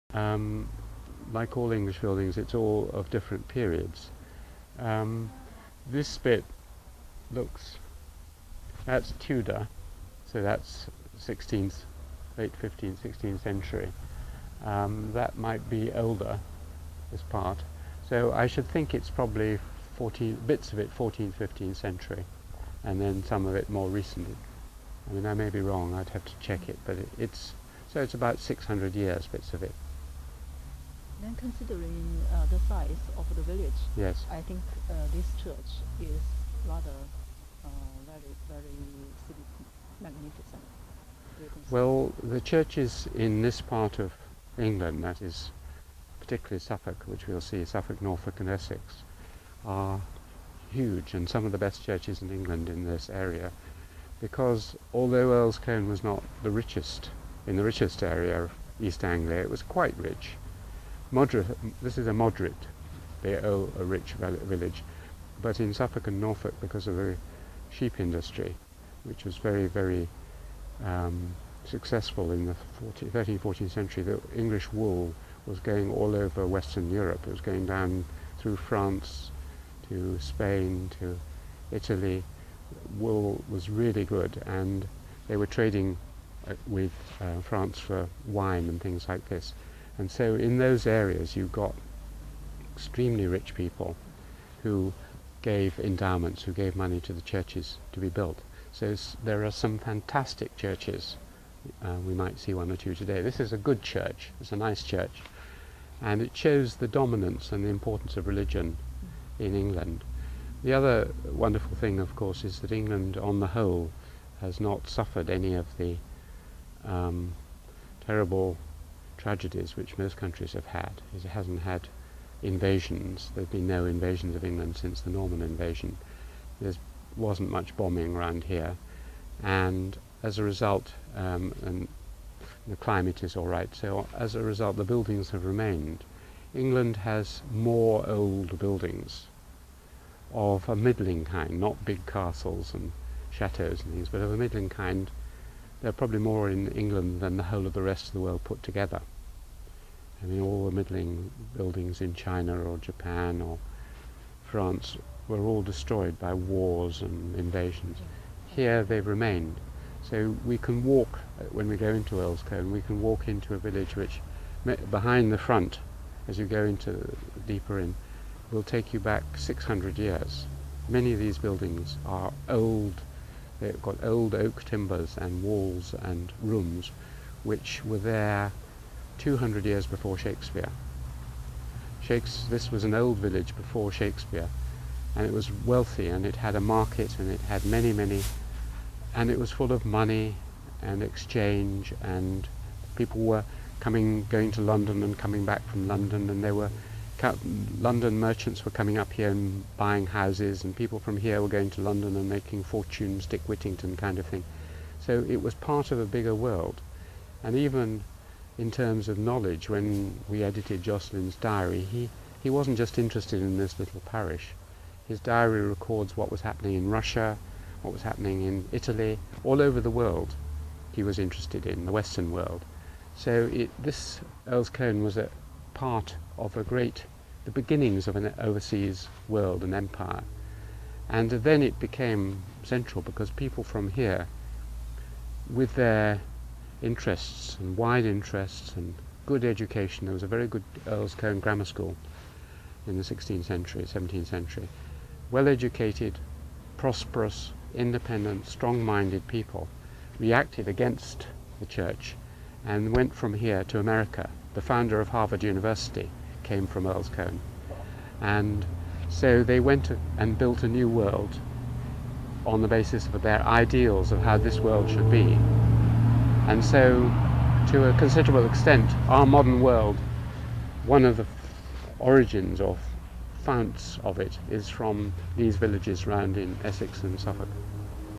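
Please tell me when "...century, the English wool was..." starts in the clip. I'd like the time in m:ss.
1:13.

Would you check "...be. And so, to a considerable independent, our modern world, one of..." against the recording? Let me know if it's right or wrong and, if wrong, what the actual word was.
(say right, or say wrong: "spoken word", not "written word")
wrong: "extent", not "independent".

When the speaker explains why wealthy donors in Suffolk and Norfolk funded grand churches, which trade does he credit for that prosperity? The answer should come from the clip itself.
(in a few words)
sheep industry.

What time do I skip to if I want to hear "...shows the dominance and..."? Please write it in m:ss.
1:46.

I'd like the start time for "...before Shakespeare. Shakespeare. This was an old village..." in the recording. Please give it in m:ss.
2:59.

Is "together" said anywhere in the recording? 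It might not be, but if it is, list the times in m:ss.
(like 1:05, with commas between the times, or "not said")
2:28.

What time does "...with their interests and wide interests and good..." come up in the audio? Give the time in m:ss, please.
3:55.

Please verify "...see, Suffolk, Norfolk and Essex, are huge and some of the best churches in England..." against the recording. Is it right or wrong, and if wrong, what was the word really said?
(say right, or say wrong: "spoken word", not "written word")
right.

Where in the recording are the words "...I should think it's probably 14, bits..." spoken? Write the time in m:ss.
0:18.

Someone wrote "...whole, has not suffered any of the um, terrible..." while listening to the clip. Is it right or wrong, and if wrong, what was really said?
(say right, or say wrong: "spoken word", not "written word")
right.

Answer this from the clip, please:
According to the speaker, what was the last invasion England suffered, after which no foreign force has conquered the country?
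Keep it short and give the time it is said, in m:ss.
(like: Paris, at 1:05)
Norman invasion, at 2:05.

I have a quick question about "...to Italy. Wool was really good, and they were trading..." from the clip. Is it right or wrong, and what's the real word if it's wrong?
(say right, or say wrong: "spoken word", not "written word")
right.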